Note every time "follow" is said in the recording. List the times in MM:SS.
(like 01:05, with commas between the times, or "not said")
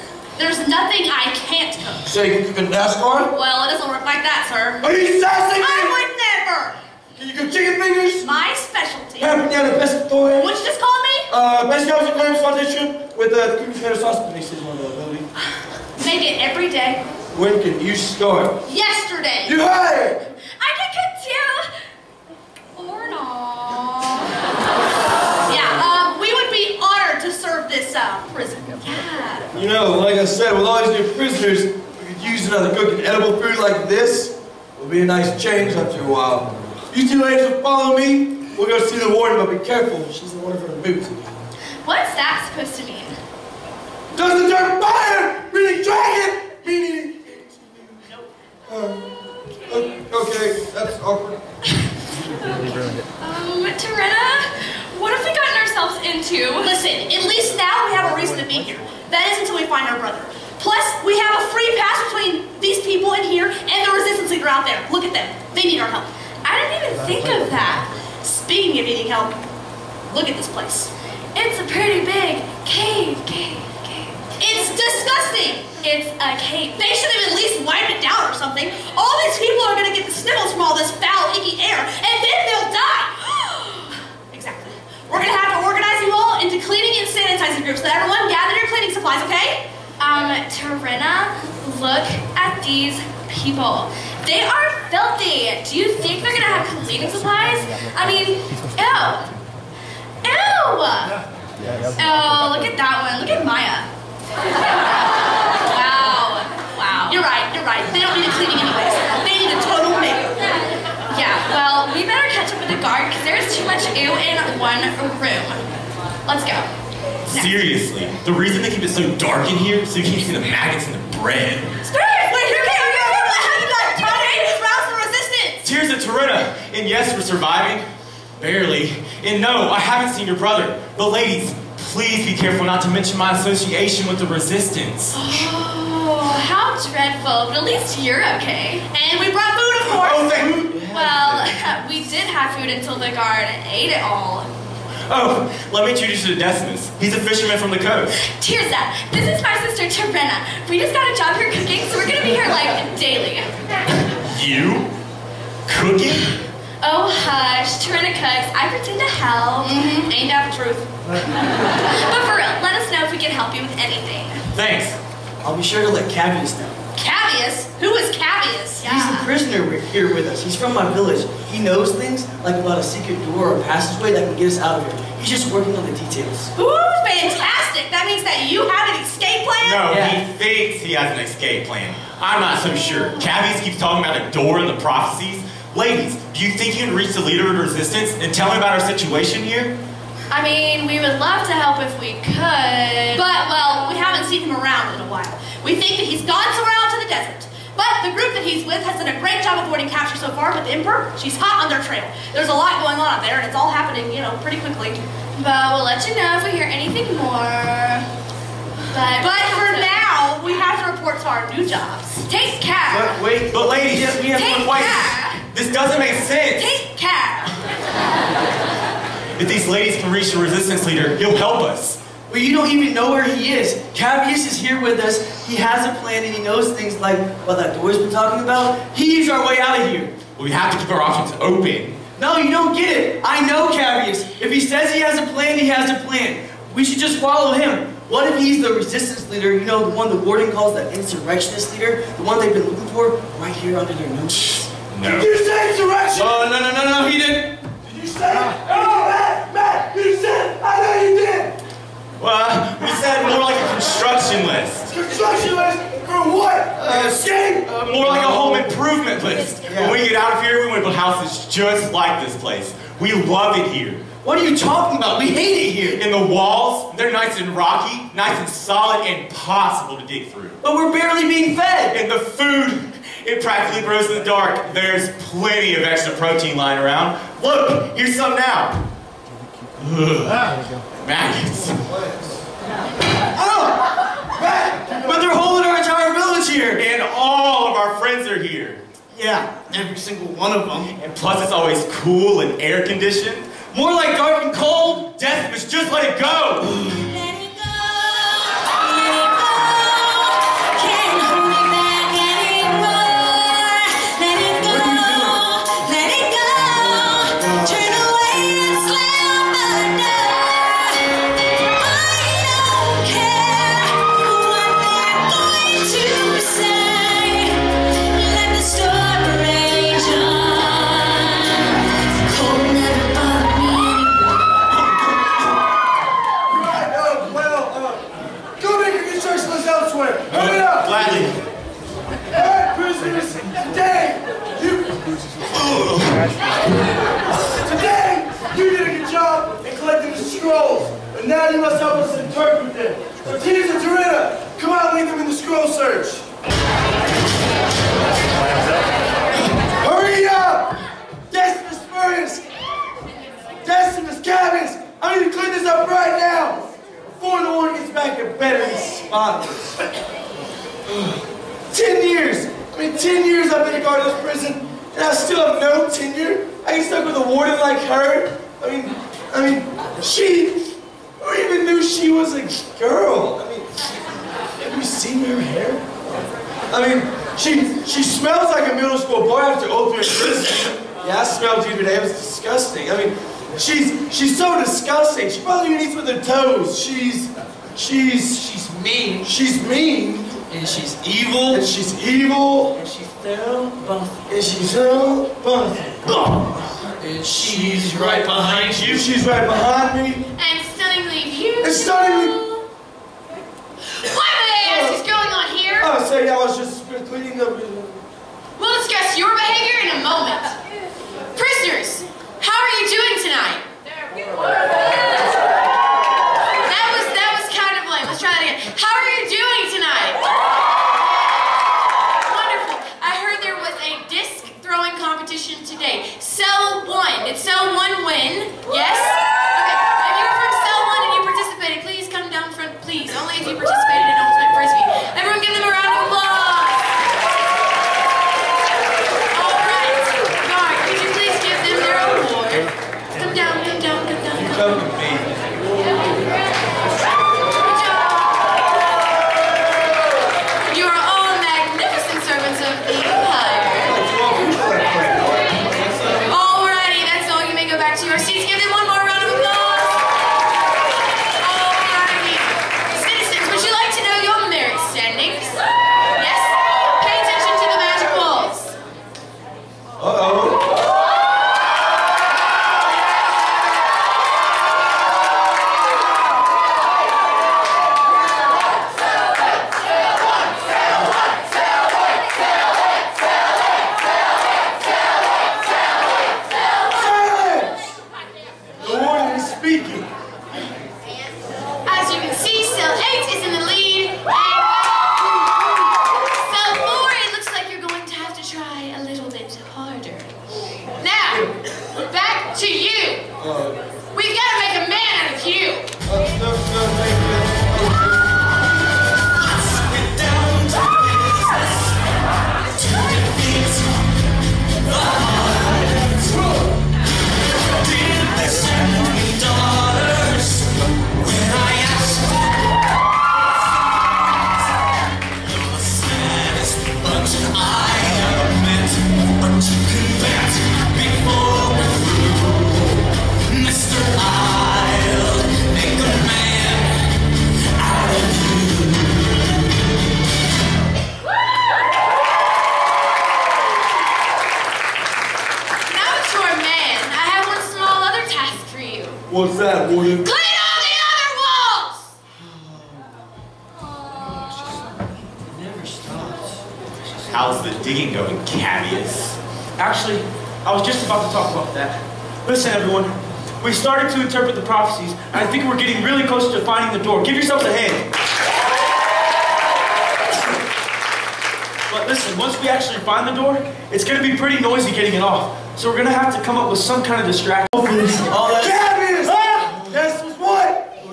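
00:37, 03:57.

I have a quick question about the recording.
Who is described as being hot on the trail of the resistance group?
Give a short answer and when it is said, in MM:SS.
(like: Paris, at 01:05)
The Emperor, at 03:20.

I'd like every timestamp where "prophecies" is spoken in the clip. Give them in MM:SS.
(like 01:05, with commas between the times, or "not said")
03:04, 09:24.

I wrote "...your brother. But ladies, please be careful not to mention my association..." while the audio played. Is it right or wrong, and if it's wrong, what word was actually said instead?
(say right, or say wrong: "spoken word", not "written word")
right.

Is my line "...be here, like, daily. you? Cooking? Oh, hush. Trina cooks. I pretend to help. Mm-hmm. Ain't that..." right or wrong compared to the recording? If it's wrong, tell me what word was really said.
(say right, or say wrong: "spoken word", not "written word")
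right.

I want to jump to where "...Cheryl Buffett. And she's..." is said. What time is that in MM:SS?
06:33.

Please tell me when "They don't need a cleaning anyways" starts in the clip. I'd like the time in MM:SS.
01:47.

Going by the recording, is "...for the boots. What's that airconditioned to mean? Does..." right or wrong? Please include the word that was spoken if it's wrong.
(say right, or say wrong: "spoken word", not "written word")
wrong: "supposed", not "airconditioned".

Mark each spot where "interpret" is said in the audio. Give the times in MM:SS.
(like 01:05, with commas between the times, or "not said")
05:42, 09:24.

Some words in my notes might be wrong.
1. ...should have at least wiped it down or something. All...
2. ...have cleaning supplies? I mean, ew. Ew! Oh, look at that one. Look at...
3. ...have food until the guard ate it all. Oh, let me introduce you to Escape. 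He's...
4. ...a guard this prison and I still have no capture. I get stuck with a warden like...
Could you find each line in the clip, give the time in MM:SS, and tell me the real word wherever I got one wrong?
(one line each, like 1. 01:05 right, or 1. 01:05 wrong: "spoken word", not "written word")
1. 01:16 right
2. 01:36 right
3. 02:22 wrong: "Decimus", not "Escape"
4. 06:03 wrong: "tenure", not "capture".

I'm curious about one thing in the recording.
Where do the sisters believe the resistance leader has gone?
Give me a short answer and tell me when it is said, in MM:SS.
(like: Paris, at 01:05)
The desert, at 03:16.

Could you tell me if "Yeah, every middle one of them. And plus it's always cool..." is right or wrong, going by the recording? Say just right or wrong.
wrong.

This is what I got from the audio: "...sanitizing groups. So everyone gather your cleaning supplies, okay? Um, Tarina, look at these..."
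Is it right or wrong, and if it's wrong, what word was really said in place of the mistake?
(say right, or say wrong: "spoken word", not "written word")
right.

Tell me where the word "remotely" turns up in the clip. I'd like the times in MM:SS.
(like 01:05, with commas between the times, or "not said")
not said.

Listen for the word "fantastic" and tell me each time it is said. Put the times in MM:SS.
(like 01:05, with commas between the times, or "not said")
02:57.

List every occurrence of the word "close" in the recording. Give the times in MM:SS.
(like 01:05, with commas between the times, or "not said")
09:26.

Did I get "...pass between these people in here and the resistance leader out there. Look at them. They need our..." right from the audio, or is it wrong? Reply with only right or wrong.
right.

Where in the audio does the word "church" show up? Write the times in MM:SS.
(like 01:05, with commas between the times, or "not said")
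not said.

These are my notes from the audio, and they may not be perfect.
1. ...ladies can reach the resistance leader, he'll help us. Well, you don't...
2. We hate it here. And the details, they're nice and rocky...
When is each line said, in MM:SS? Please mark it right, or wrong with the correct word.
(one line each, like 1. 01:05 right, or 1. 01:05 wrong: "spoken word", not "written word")
1. 03:39 right
2. 04:25 wrong: "walls", not "details".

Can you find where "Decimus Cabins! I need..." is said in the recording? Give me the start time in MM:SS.
05:53.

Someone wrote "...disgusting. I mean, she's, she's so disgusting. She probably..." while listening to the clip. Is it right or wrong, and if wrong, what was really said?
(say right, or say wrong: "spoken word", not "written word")
right.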